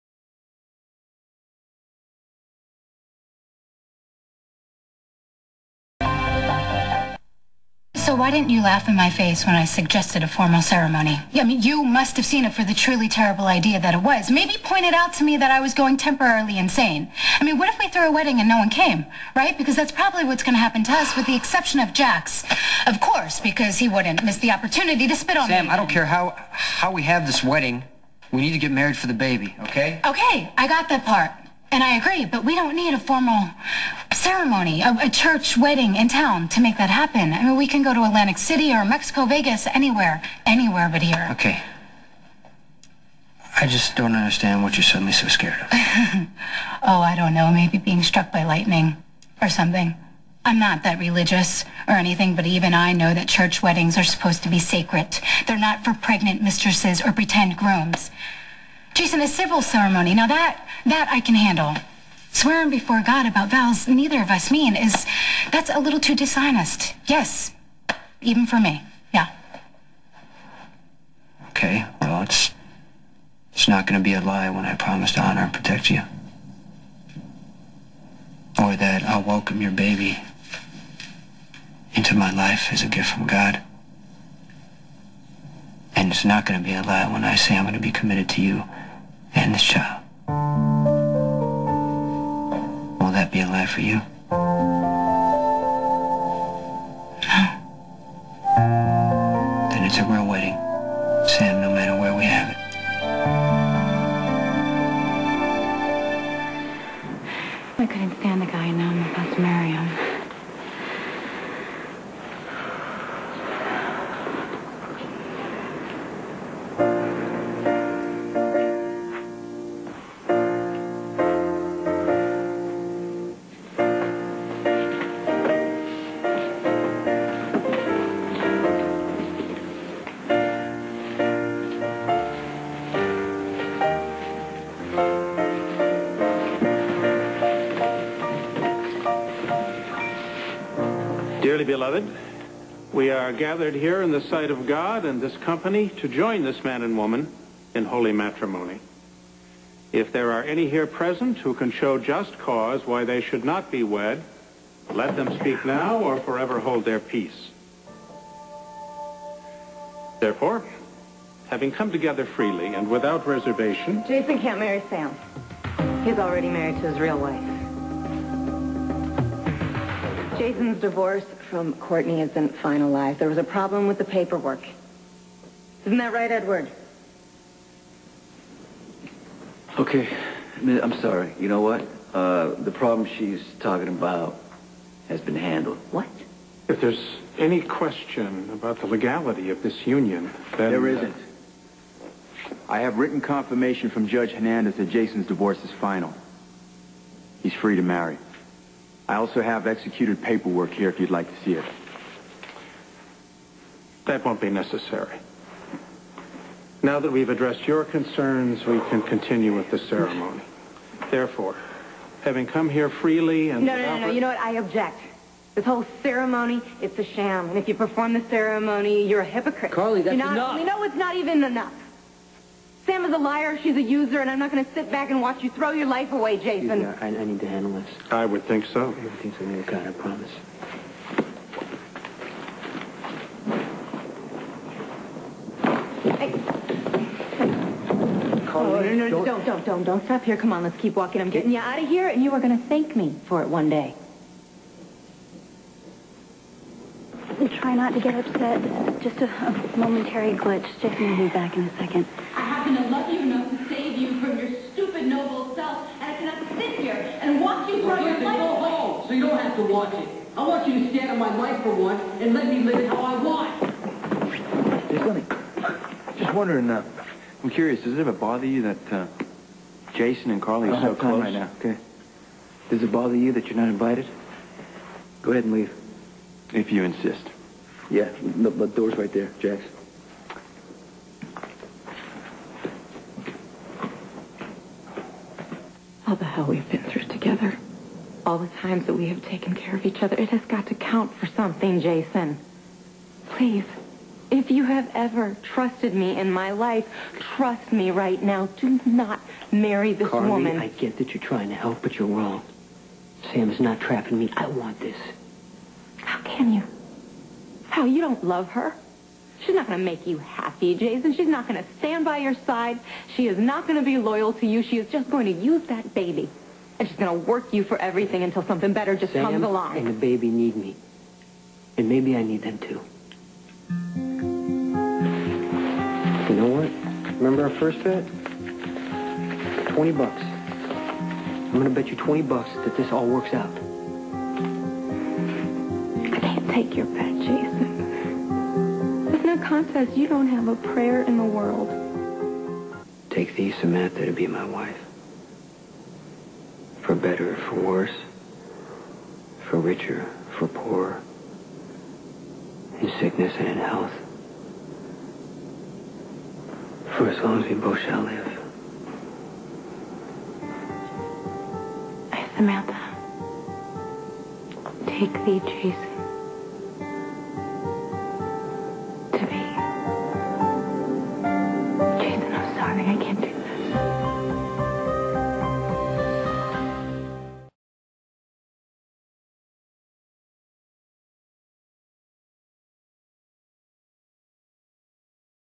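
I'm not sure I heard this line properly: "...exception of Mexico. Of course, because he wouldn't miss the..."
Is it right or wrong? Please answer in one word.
wrong.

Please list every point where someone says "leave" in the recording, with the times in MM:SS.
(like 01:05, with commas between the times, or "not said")
04:35.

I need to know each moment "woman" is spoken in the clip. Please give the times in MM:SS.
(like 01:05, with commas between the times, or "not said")
02:26, 05:00.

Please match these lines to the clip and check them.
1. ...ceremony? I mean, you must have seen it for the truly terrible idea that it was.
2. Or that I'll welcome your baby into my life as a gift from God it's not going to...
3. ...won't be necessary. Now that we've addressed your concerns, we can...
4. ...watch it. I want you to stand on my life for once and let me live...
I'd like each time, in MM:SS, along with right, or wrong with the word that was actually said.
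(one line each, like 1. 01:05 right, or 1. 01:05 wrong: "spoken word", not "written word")
1. 00:10 right
2. 01:18 right
3. 03:24 right
4. 04:19 right.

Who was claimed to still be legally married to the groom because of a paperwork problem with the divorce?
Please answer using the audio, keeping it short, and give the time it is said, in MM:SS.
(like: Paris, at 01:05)
Courtney, at 02:51.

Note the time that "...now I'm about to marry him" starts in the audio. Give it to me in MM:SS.
01:48.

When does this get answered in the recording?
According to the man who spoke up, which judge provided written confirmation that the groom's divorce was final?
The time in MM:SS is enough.
03:14.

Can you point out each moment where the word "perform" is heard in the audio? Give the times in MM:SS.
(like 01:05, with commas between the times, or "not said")
03:37.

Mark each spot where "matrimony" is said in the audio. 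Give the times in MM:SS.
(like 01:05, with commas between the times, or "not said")
02:28.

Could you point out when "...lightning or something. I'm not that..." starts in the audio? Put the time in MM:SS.
00:48.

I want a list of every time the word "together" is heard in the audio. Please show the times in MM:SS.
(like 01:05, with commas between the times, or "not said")
02:41, 04:47.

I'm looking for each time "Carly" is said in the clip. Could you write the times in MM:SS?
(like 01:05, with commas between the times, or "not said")
03:39, 04:30, 05:00.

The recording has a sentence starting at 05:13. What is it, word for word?
She is not going to be loyal to you.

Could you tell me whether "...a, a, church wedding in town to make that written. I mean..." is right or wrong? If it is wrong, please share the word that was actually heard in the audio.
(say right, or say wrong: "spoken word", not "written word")
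wrong: "happen", not "written".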